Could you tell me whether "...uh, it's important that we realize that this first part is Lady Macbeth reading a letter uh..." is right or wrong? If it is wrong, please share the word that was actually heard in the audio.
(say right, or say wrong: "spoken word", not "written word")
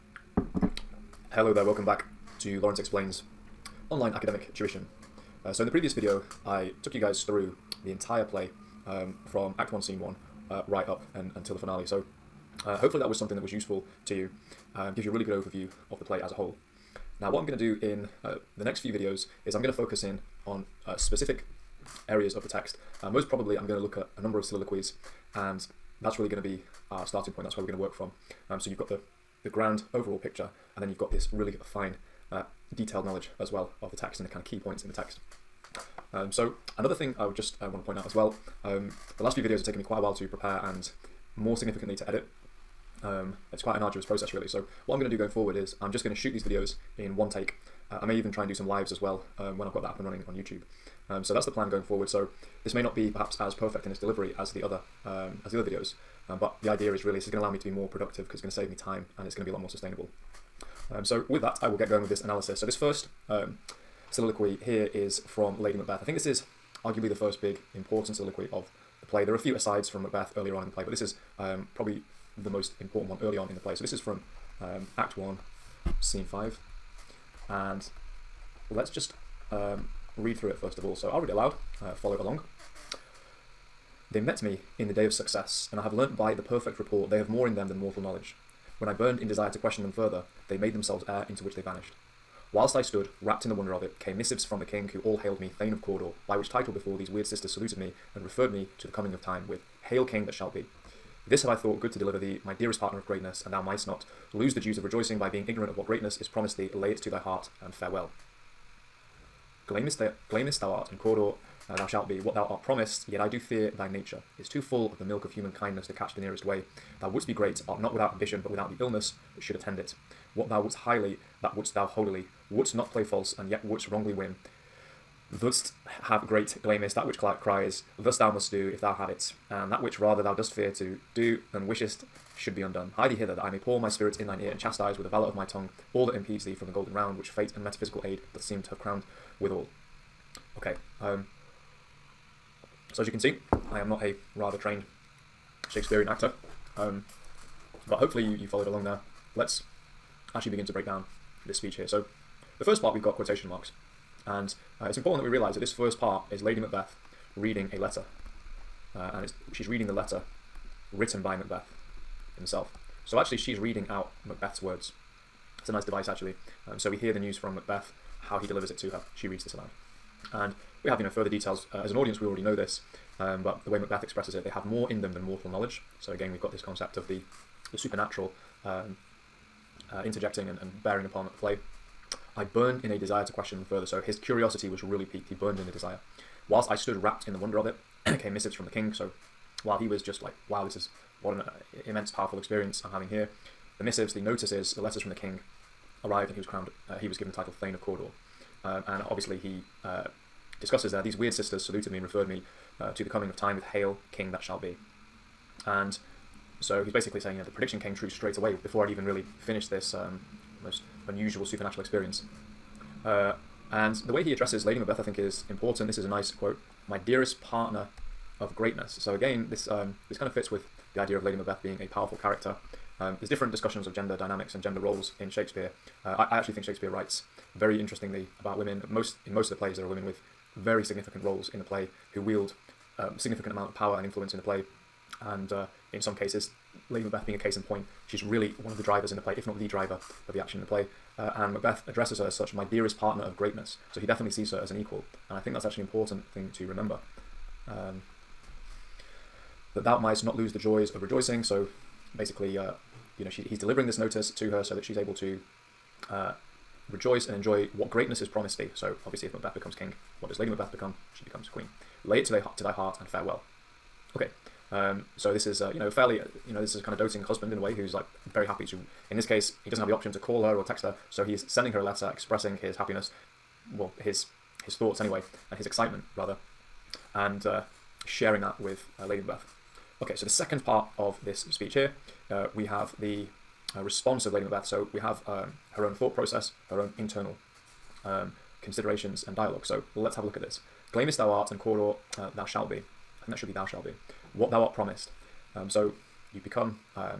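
right.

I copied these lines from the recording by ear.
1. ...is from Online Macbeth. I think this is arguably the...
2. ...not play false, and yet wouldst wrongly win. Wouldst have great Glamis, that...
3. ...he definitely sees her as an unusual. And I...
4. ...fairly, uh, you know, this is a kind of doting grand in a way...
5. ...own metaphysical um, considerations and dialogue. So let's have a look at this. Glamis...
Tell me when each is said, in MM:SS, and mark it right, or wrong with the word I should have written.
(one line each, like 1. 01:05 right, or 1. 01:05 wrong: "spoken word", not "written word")
1. 01:04 wrong: "Lady", not "Online"
2. 02:02 right
3. 04:03 wrong: "equal", not "unusual"
4. 04:25 wrong: "husband", not "grand"
5. 04:46 wrong: "internal", not "metaphysical".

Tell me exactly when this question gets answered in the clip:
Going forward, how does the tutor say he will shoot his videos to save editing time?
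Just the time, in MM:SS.
00:46.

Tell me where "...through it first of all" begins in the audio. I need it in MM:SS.
01:20.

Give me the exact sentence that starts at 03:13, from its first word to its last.
The missives, the notices, the letters from the king arrived, and he was crowned.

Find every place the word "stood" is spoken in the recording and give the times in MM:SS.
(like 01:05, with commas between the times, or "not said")
01:32, 03:06.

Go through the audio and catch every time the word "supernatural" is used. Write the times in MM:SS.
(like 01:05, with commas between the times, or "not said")
02:57, 03:31.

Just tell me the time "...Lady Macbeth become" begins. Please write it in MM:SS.
04:20.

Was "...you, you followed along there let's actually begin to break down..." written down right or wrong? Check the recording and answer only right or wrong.
right.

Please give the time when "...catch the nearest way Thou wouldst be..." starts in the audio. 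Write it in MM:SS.
01:55.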